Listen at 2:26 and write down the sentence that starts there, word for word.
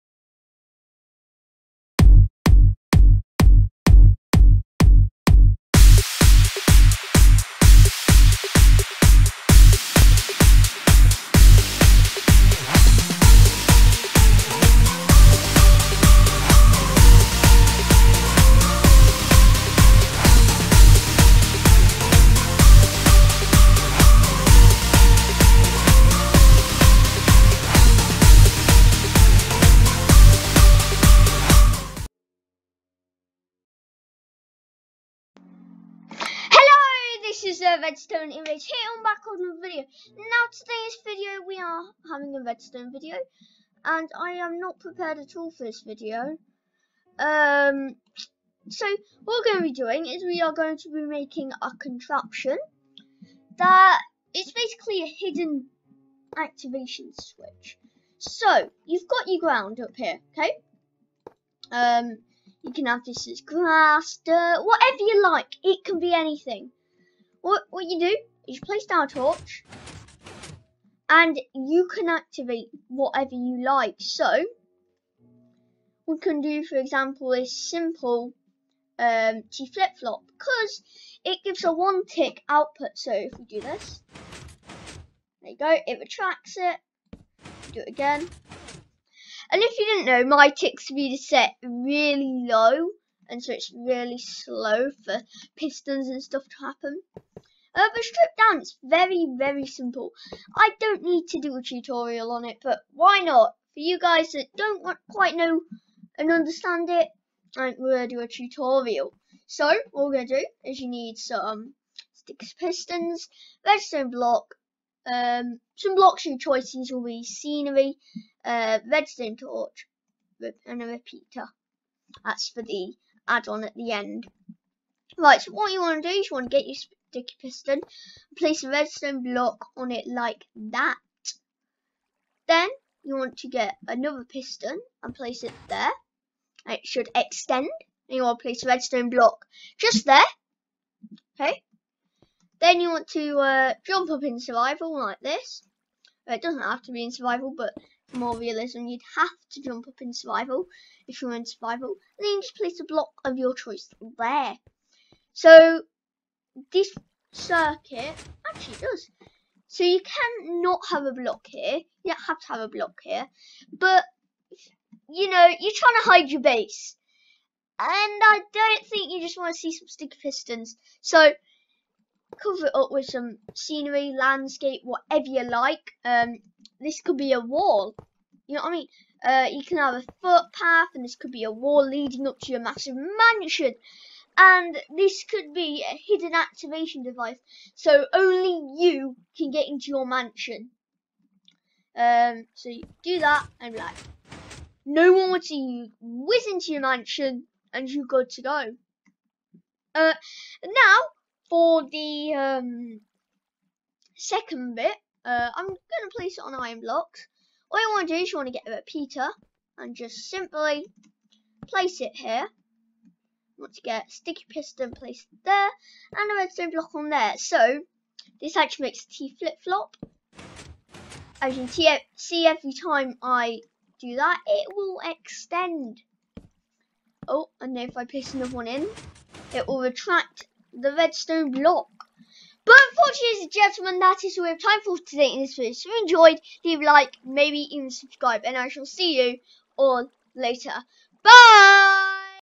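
It doesn't have to be in survival, but more realism, you'd have to jump up in survival if you're in survival.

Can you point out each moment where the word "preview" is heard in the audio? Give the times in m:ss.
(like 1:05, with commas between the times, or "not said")
not said.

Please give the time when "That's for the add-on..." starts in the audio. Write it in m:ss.
2:02.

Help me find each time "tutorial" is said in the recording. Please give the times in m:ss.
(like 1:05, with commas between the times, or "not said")
1:41, 1:48.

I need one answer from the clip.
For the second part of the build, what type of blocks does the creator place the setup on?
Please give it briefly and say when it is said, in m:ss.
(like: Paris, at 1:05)
Iron blocks, at 3:26.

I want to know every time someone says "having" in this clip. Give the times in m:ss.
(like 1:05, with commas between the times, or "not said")
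0:42.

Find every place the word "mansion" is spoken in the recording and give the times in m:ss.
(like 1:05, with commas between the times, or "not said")
3:02, 3:10, 3:16.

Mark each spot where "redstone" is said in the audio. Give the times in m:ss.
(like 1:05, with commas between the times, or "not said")
0:37, 0:42, 1:53, 1:58, 2:08, 2:18, 3:36, 3:50.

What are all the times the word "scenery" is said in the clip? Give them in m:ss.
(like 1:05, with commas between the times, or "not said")
1:57, 2:53.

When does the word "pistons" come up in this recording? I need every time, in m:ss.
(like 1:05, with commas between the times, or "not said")
1:35, 1:52, 2:07, 2:14, 2:50, 3:34.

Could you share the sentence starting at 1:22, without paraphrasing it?
So if we do this, there you go, it retracts it.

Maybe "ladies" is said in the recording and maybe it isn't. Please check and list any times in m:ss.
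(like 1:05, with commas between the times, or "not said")
3:53.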